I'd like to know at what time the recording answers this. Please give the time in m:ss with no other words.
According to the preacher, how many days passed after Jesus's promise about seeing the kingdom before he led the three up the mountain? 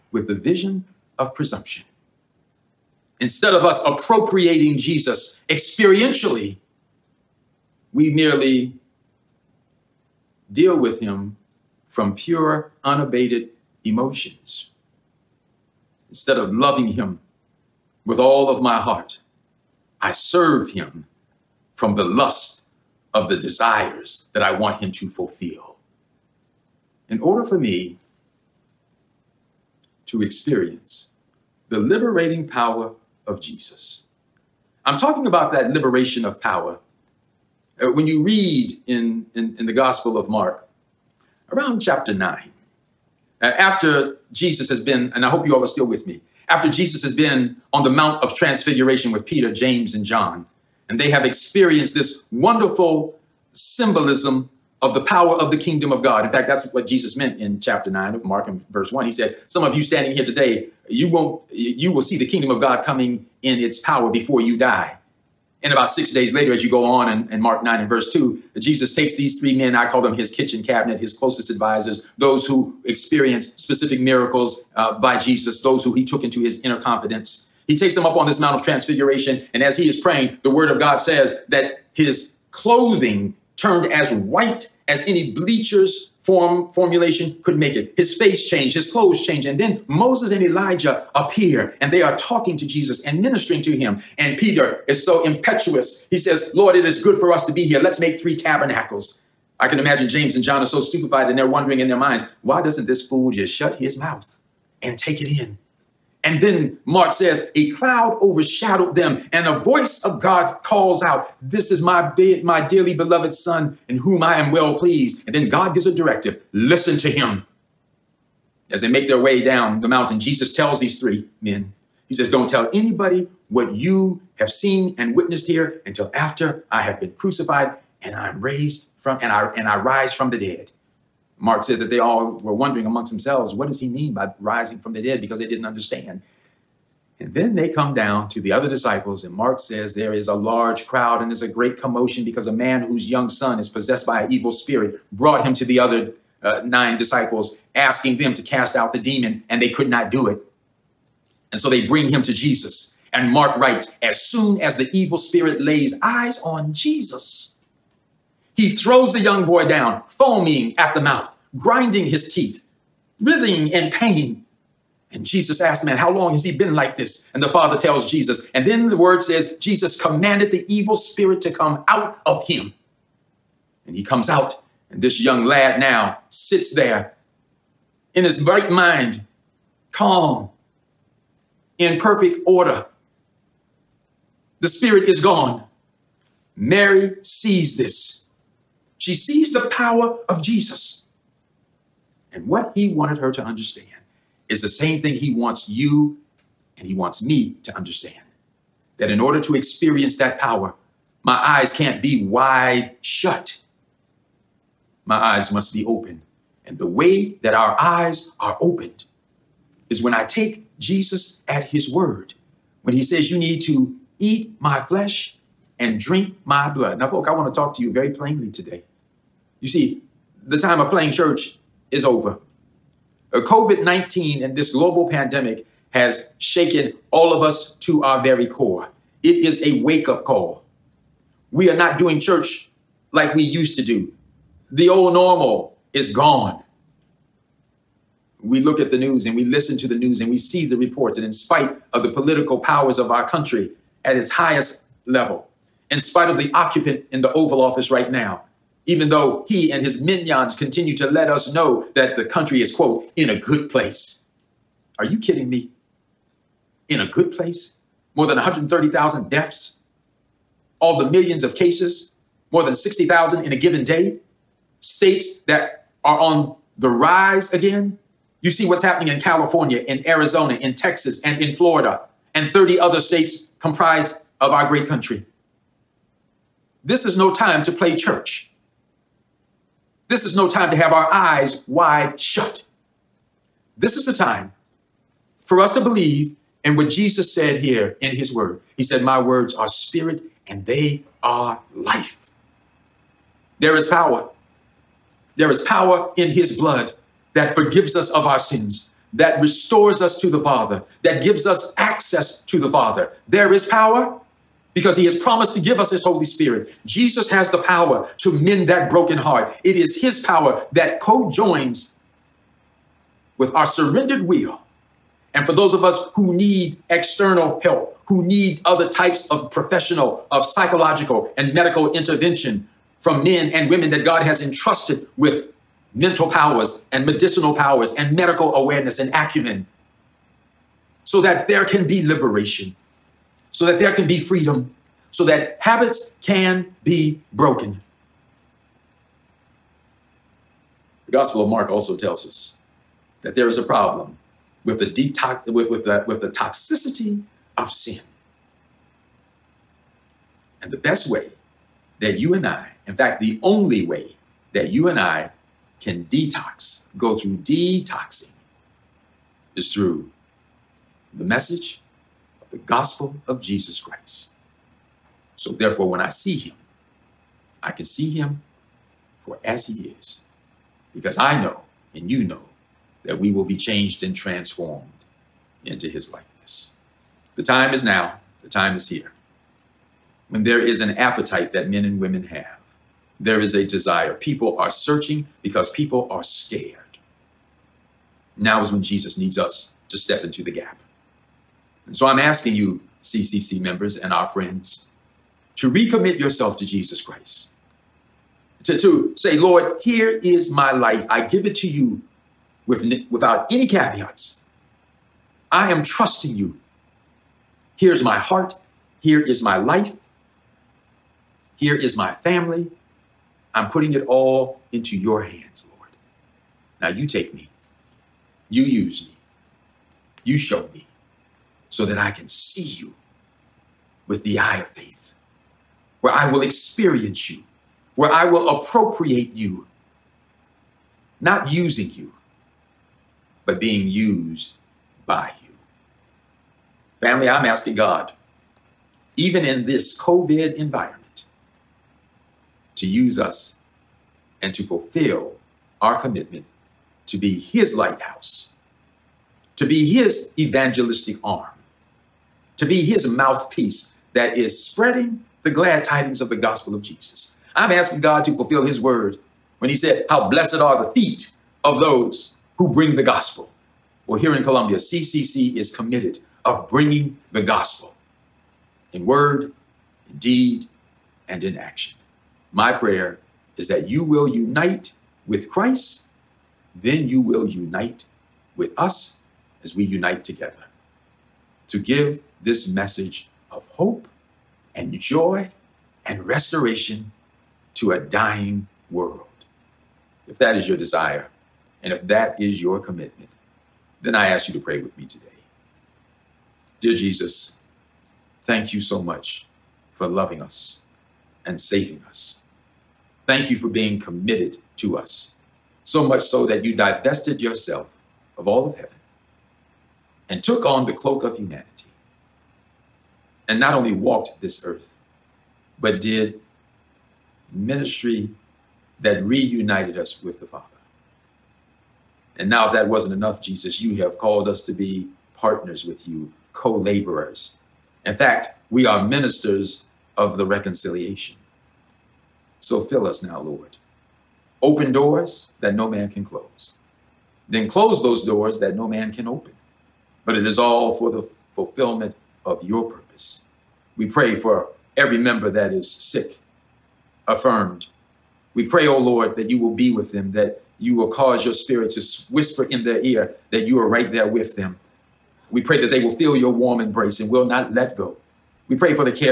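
1:05.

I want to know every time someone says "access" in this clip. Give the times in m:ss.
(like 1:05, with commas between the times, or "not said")
5:01.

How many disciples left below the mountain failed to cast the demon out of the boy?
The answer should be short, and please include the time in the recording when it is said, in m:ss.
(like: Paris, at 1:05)
9, at 2:26.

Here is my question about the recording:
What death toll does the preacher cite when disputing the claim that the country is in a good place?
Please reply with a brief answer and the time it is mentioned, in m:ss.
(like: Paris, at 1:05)
More than 130,000, at 4:18.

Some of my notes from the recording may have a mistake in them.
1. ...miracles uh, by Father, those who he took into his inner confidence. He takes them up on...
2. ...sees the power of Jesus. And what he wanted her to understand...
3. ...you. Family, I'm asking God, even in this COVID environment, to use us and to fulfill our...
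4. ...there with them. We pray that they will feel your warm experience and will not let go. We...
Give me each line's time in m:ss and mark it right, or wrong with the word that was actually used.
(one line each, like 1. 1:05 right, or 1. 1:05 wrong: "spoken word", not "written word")
1. 1:13 wrong: "Jesus", not "Father"
2. 3:09 right
3. 7:15 right
4. 9:14 wrong: "embrace", not "experience".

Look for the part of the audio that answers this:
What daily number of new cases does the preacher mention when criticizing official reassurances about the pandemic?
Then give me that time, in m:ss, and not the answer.
4:22.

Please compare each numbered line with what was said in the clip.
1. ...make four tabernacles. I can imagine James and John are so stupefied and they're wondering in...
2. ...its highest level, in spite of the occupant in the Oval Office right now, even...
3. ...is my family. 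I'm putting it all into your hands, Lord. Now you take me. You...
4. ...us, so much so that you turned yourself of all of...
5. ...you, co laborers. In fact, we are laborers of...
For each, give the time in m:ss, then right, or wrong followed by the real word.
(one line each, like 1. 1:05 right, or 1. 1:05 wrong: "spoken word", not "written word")
1. 1:37 wrong: "three", not "four"
2. 4:04 right
3. 6:51 right
4. 8:24 wrong: "divested", not "turned"
5. 8:46 wrong: "ministers", not "laborers".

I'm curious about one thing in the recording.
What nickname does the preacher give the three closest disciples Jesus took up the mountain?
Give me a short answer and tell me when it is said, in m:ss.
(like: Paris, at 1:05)
kitchen cabinet, at 1:10.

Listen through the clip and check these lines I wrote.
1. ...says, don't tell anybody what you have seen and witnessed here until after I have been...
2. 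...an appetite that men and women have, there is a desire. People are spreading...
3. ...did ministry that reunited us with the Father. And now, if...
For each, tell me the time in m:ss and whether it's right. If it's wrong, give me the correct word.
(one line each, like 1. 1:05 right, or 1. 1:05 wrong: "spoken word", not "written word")
1. 2:02 right
2. 6:20 wrong: "searching", not "spreading"
3. 8:35 right.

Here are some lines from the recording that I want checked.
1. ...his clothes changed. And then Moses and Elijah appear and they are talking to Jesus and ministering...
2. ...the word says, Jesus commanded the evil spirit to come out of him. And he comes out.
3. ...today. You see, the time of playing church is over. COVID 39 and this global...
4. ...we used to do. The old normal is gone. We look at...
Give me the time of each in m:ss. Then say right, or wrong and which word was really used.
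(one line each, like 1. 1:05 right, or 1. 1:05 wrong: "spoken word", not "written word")
1. 1:28 right
2. 2:48 right
3. 3:38 wrong: "19", not "39"
4. 3:53 right.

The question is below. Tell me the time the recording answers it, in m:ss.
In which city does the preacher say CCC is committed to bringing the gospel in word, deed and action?
7:44.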